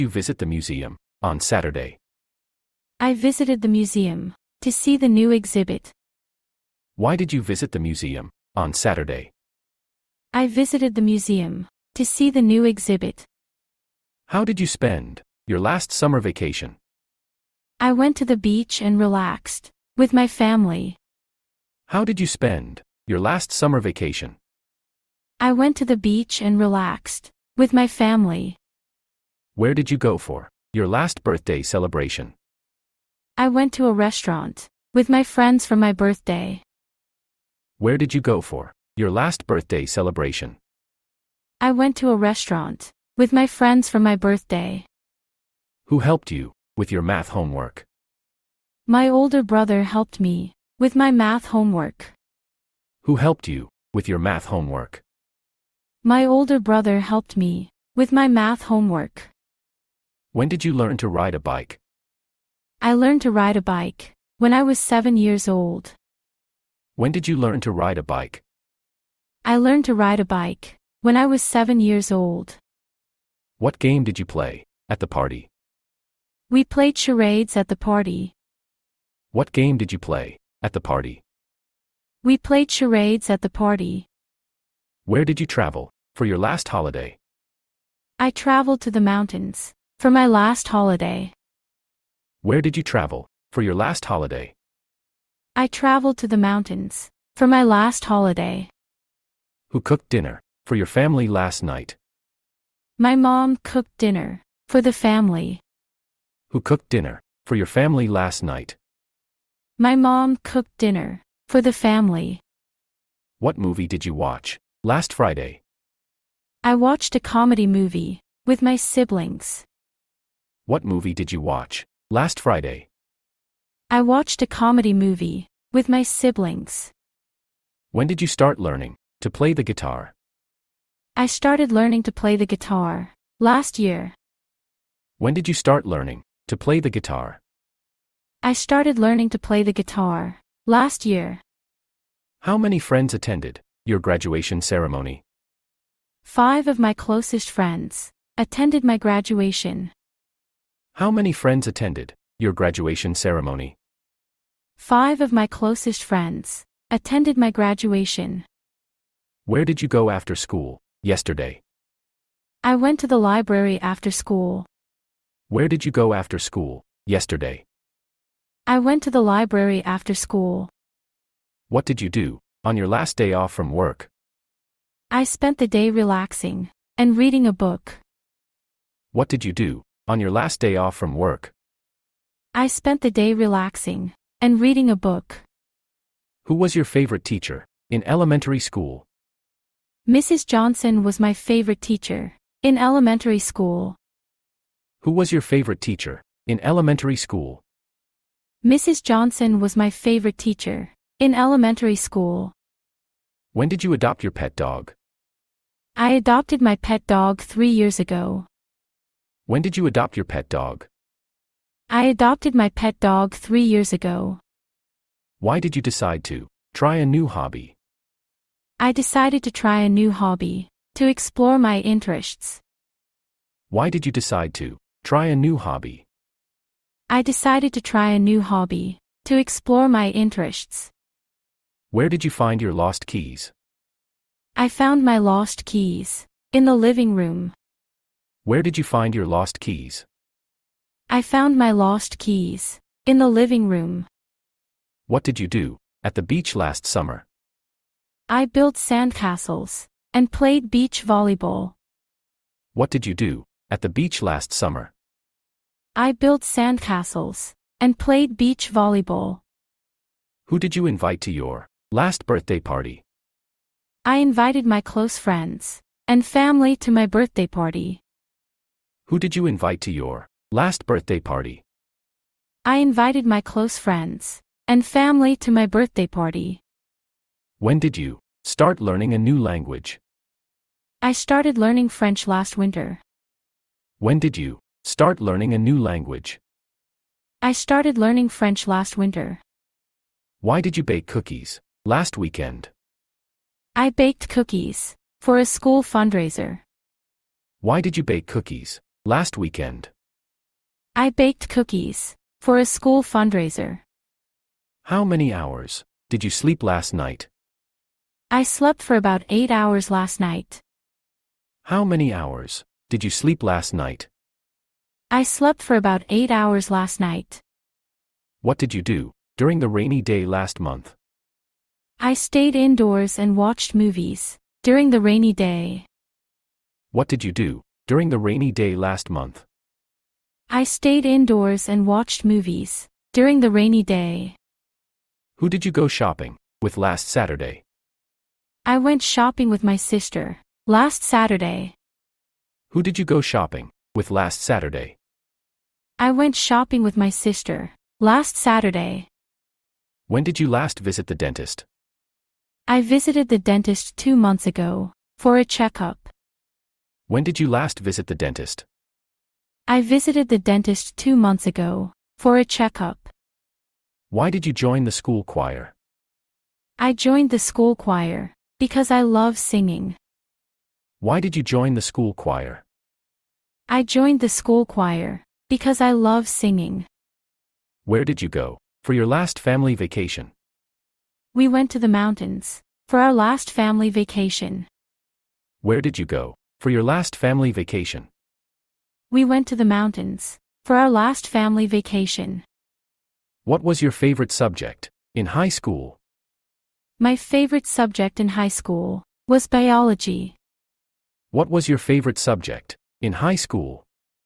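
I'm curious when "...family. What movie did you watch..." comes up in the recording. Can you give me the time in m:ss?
1:51.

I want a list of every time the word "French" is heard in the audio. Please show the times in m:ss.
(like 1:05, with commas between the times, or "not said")
4:41, 4:48.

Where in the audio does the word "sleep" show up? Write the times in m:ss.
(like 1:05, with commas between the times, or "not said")
5:06, 5:13.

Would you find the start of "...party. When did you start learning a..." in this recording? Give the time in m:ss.
4:36.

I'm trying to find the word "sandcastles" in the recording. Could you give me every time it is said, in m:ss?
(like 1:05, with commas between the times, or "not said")
4:08, 4:16.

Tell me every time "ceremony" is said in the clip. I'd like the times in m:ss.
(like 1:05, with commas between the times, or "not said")
2:24, 2:33.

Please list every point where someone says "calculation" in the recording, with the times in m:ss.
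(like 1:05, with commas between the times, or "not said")
not said.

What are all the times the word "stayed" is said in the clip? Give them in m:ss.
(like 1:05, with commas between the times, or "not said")
5:22, 5:30.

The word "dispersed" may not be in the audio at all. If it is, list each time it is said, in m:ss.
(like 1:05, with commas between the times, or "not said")
not said.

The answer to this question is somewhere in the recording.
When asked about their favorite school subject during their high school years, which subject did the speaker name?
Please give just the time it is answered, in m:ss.
6:39.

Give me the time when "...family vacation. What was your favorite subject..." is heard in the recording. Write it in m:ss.
6:31.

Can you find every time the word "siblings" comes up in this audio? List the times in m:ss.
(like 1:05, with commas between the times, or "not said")
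1:58, 2:06.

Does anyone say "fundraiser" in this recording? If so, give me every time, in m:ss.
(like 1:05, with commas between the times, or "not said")
4:55, 5:03.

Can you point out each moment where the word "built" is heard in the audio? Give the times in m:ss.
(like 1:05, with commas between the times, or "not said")
4:08, 4:16.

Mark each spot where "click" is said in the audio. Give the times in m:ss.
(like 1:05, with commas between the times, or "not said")
not said.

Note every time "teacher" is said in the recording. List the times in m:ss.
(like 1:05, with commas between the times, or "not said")
3:07, 3:11, 3:15, 3:20.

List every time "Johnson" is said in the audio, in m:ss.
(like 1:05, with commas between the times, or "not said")
3:10, 3:19.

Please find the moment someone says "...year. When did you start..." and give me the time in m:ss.
2:13.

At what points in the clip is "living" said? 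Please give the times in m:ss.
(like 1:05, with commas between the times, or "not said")
3:56, 4:03.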